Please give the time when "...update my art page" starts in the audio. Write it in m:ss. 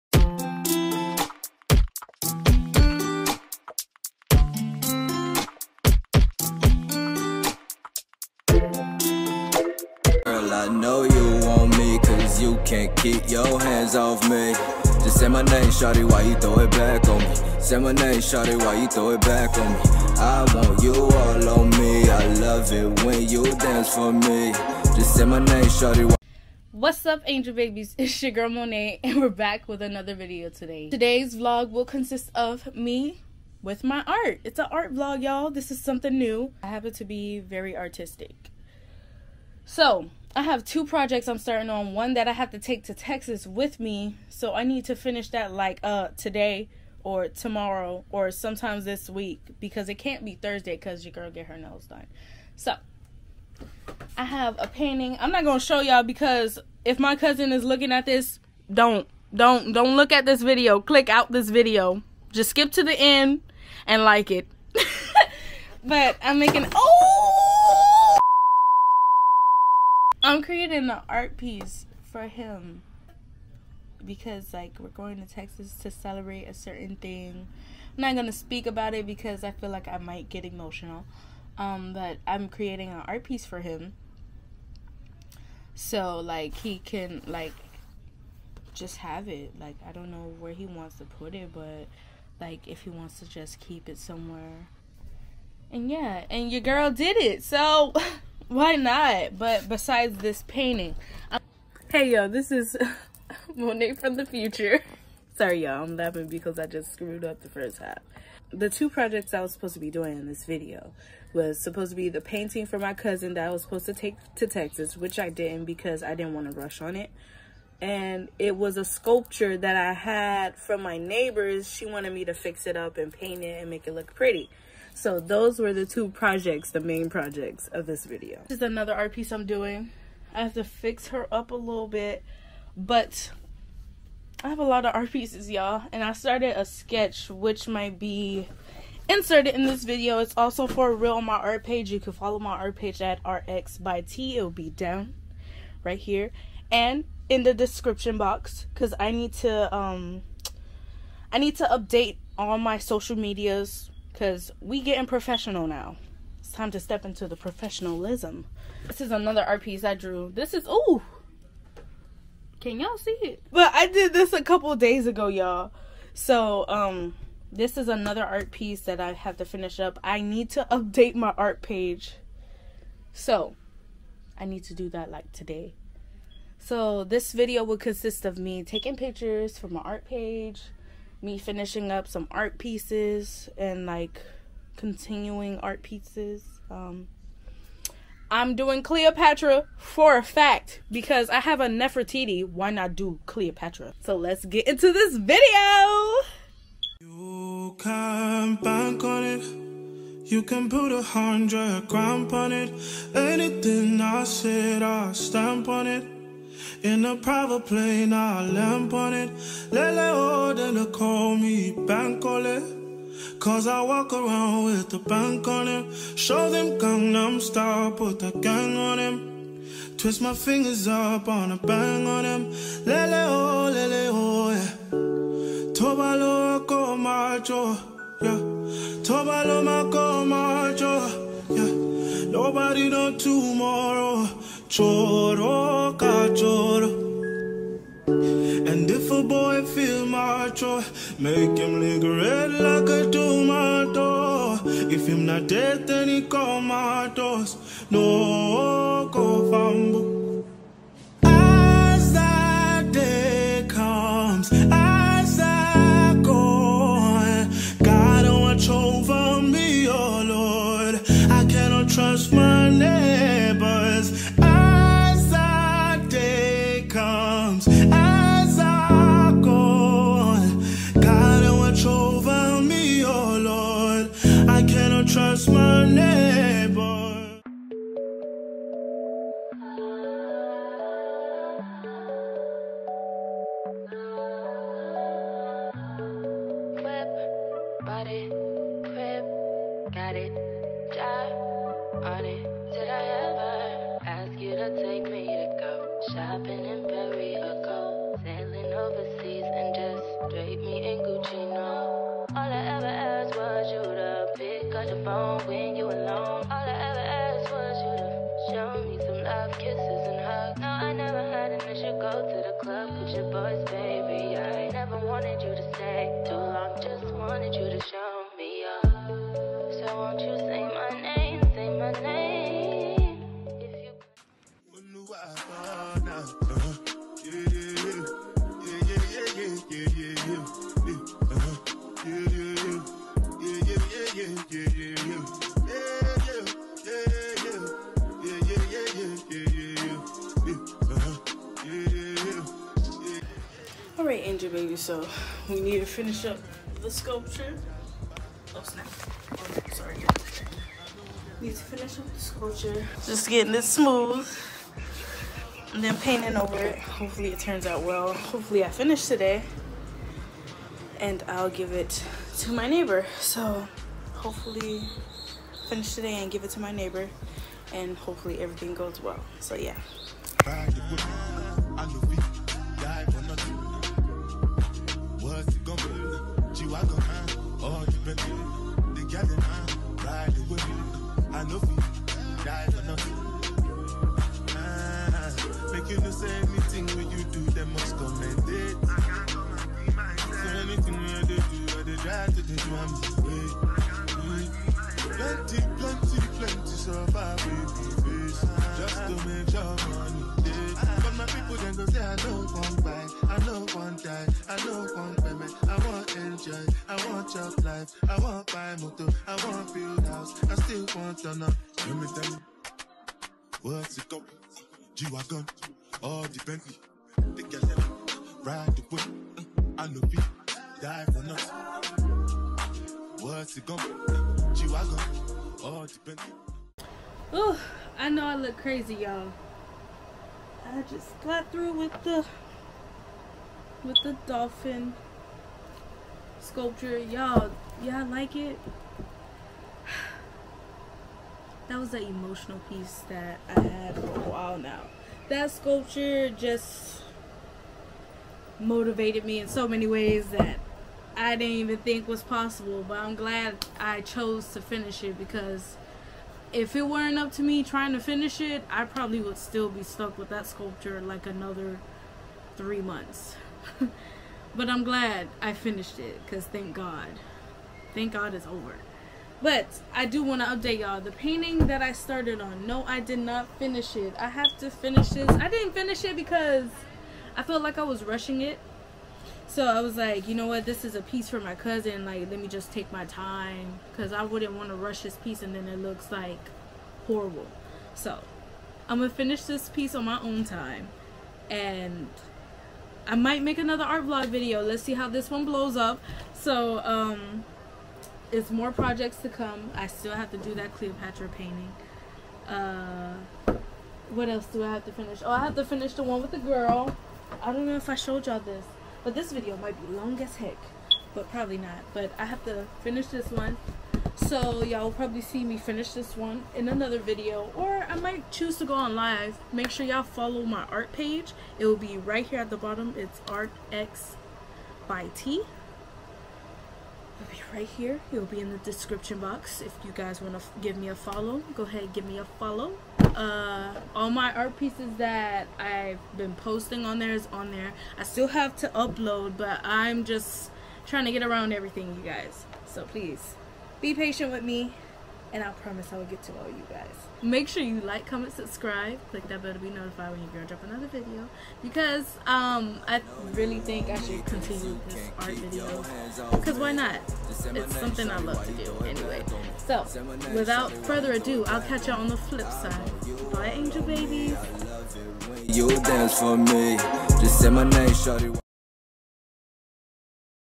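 2:50.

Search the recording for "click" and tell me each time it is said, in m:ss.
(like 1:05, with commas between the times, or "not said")
1:00, 9:09.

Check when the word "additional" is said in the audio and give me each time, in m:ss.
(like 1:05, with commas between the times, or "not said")
not said.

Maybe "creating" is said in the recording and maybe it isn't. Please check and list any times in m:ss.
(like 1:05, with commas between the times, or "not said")
1:10, 1:22.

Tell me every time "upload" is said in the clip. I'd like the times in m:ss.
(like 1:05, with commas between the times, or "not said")
8:58.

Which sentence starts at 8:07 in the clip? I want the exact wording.
So I'm gonna finish this piece on my own time and I might make another art vlog video.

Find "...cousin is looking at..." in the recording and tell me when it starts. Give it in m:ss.
0:57.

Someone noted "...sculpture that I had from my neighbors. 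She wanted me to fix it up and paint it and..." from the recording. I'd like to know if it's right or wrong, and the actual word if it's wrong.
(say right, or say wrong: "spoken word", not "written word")
right.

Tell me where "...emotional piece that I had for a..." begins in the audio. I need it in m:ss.
7:22.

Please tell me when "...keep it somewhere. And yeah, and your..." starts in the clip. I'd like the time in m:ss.
1:33.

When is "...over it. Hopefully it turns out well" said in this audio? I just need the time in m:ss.
5:56.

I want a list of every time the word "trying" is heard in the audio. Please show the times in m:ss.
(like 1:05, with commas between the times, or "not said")
7:37, 9:00.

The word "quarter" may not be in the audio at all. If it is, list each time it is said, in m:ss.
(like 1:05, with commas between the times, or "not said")
not said.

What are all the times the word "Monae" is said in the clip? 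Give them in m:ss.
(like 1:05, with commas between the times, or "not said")
0:28, 1:43.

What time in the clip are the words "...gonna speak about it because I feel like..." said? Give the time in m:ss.
1:18.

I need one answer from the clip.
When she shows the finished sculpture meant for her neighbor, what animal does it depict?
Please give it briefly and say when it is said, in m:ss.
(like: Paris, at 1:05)
Dolphin, at 7:14.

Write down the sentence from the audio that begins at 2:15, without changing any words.
And I started a sketch, which might be inserted in this video.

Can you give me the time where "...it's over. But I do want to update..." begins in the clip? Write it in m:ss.
7:48.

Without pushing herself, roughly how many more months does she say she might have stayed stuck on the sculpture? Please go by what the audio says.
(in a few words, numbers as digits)
3 months.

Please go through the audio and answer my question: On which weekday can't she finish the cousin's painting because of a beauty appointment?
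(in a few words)
Thursday.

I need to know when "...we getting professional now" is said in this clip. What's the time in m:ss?
2:34.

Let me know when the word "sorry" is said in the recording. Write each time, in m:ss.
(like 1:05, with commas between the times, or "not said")
1:45, 5:49.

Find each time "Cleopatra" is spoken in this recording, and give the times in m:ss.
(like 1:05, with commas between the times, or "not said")
3:08, 3:13, 8:20.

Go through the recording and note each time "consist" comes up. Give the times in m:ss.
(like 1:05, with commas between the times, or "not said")
0:31, 2:57.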